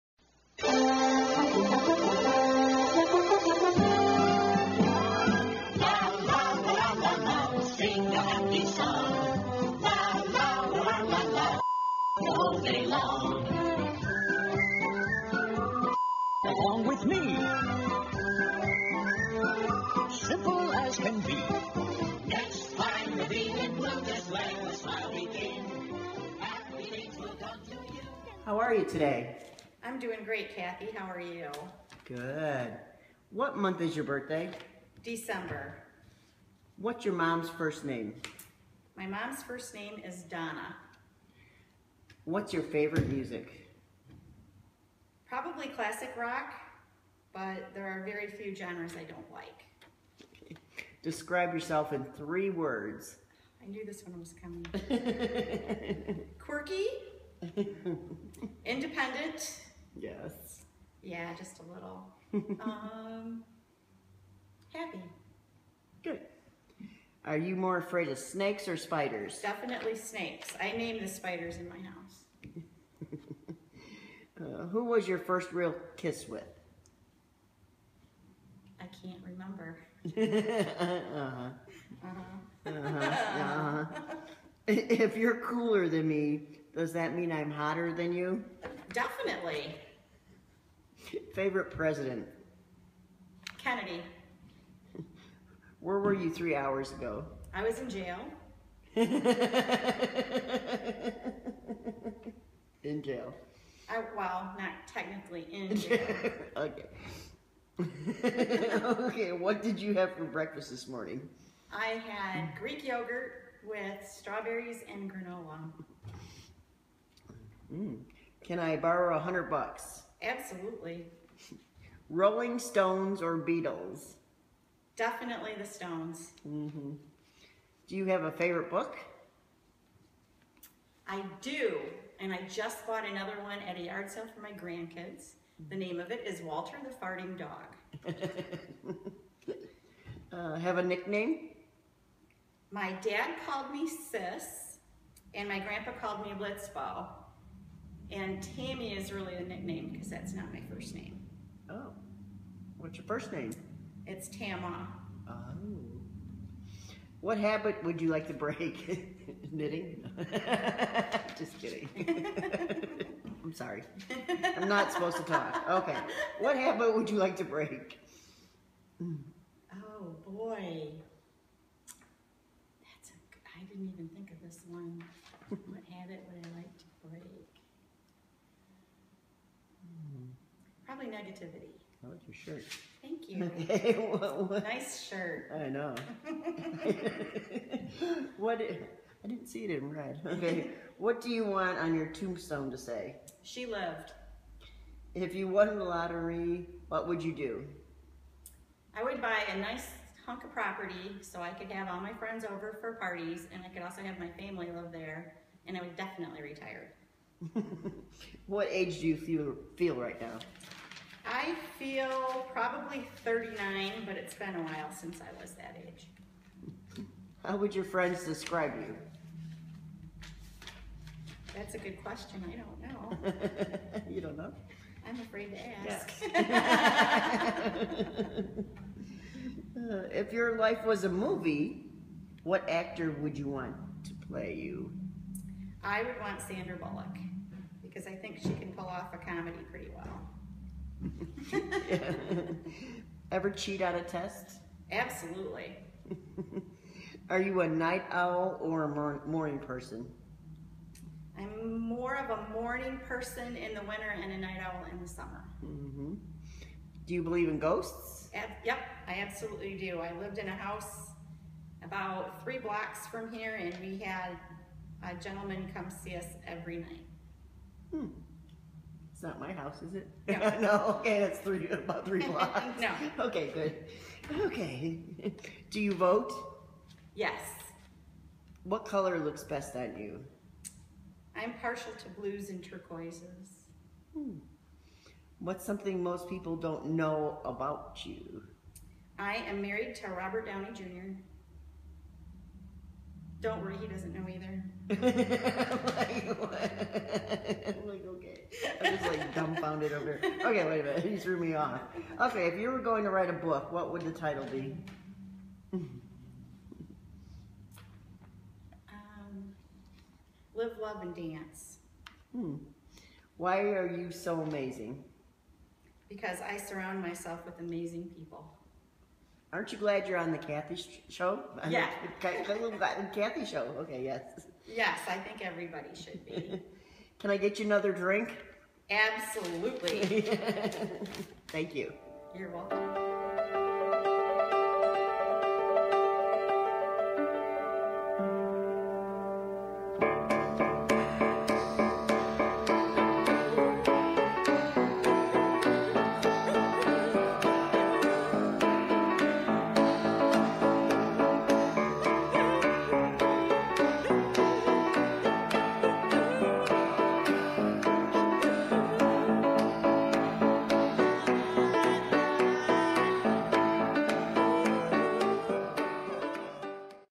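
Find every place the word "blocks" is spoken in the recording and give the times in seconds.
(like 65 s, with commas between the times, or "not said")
262 s, 272 s.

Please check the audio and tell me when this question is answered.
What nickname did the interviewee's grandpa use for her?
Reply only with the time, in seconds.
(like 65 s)
146 s.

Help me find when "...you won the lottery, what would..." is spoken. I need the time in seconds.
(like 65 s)
195 s.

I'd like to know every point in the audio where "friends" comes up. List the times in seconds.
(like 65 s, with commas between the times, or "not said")
202 s, 217 s.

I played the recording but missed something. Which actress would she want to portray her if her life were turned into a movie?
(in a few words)
Sandra Bullock.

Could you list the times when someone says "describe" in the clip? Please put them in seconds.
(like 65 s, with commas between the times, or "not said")
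51 s, 218 s.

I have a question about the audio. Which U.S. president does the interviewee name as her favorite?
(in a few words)
Kennedy.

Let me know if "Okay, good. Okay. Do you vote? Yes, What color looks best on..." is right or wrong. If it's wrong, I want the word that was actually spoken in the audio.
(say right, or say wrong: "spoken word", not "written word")
right.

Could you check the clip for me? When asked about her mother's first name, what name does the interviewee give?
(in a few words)
Donna.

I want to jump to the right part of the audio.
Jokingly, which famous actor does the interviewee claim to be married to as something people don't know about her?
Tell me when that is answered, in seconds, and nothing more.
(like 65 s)
290 s.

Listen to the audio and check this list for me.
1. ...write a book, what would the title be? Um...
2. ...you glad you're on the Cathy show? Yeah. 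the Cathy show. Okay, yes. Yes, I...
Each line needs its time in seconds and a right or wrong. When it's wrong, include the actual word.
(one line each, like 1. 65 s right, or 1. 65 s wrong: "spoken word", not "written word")
1. 303 s right
2. 319 s right.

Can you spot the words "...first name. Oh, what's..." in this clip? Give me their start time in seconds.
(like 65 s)
150 s.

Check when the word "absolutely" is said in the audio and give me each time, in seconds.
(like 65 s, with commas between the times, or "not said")
120 s, 244 s, 259 s, 328 s.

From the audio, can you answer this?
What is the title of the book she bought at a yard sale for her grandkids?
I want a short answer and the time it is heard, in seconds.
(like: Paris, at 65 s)
Walter the Farting Dog, at 136 s.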